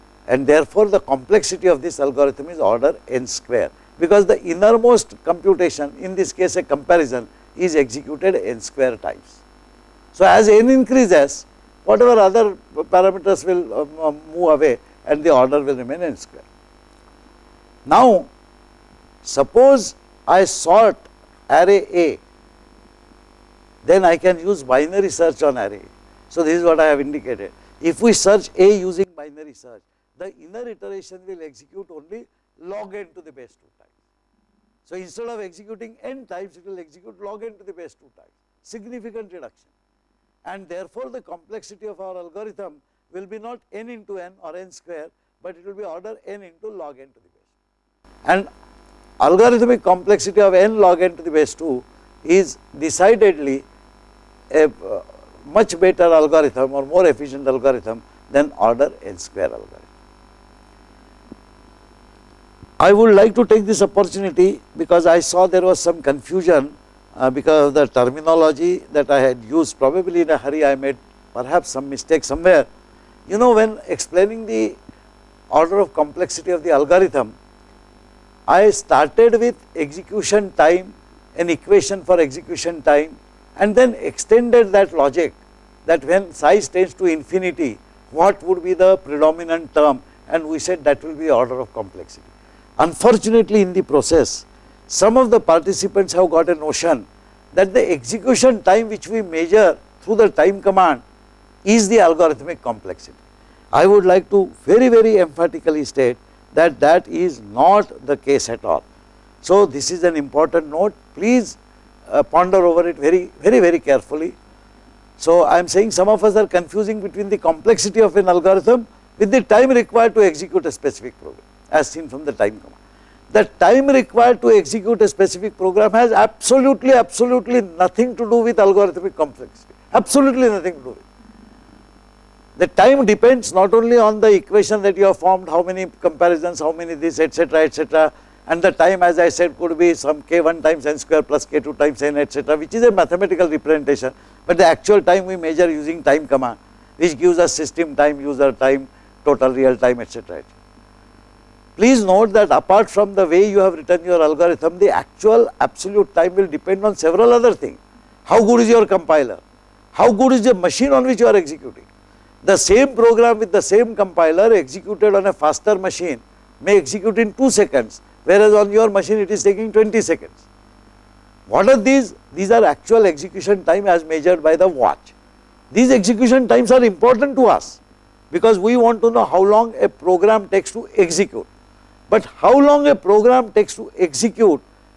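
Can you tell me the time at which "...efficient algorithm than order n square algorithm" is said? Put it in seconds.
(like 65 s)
57 s.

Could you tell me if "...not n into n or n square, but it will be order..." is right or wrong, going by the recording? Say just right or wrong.
right.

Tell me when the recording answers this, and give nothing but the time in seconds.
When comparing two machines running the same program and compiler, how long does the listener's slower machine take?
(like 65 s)
169 s.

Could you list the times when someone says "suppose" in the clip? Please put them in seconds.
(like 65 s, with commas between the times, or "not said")
19 s.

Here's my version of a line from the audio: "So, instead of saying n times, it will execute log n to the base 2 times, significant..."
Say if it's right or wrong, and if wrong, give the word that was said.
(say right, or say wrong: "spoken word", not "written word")
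wrong: "executing", not "saying".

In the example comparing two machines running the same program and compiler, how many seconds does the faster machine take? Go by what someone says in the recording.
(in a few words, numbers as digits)
2 seconds.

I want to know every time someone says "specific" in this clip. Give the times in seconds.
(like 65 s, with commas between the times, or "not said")
120 s, 125 s.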